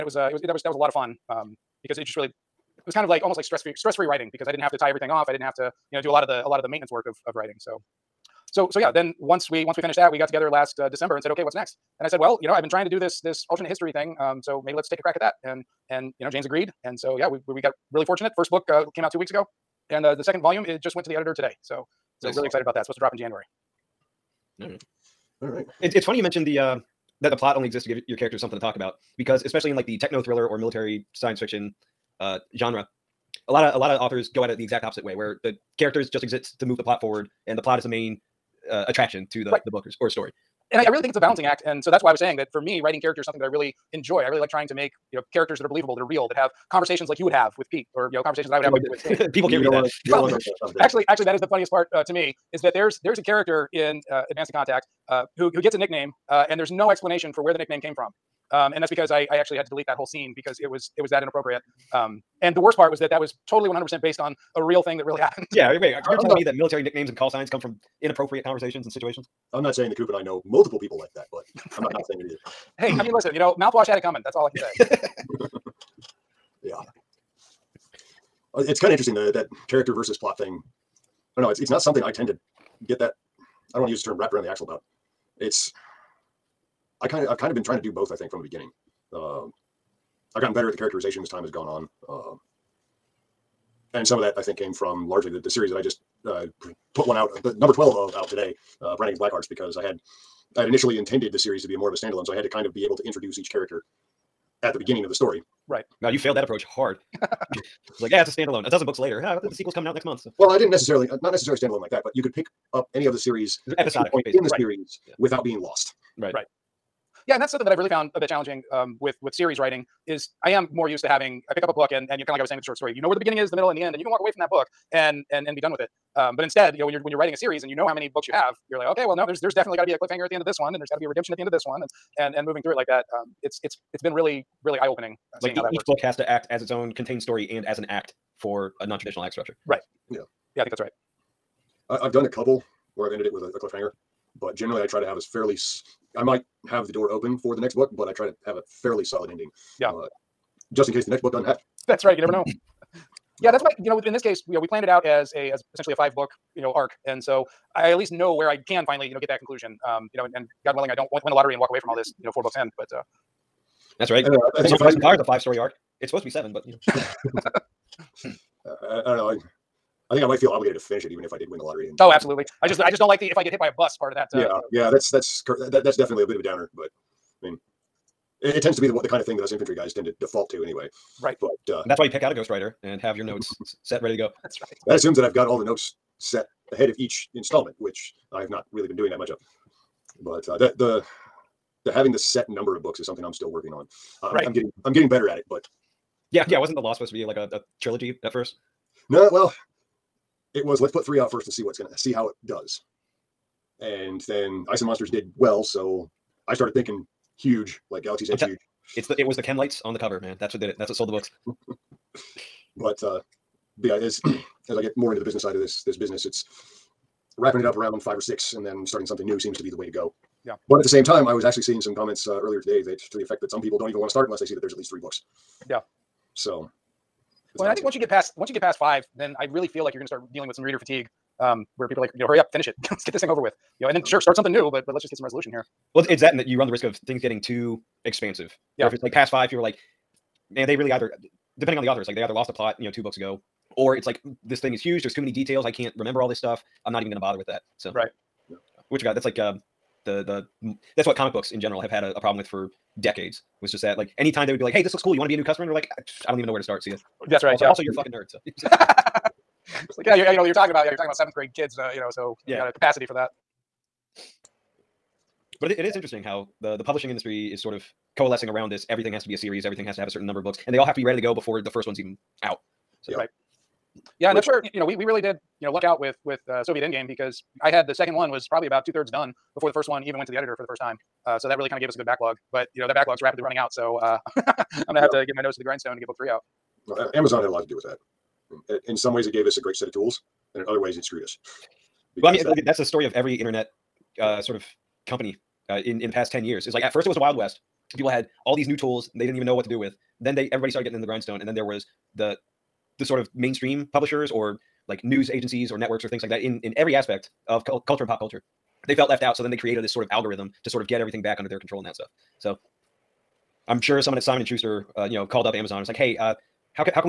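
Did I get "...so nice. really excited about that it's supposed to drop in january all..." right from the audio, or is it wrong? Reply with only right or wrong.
right.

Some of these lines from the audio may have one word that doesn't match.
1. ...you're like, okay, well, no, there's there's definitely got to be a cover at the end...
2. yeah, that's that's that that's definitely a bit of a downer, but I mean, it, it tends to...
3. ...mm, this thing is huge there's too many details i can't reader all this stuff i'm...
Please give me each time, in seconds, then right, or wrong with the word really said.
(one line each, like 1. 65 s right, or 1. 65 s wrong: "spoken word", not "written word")
1. 128 s wrong: "cliffhanger", not "cover"
2. 174 s right
3. 244 s wrong: "remember", not "reader".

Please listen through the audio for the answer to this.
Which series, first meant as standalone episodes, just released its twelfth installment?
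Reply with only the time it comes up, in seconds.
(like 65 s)
98 s.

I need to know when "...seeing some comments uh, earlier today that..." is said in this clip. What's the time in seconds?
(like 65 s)
221 s.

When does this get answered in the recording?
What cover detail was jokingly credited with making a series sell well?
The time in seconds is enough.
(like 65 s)
209 s.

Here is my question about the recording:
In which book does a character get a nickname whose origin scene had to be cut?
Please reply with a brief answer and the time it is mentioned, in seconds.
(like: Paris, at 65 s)
Advanced to Contact, at 54 s.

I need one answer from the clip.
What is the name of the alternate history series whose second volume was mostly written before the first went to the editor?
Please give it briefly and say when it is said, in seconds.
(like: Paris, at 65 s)
Soviet Endgame, at 276 s.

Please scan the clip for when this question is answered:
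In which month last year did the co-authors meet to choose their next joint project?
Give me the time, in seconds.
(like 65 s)
10 s.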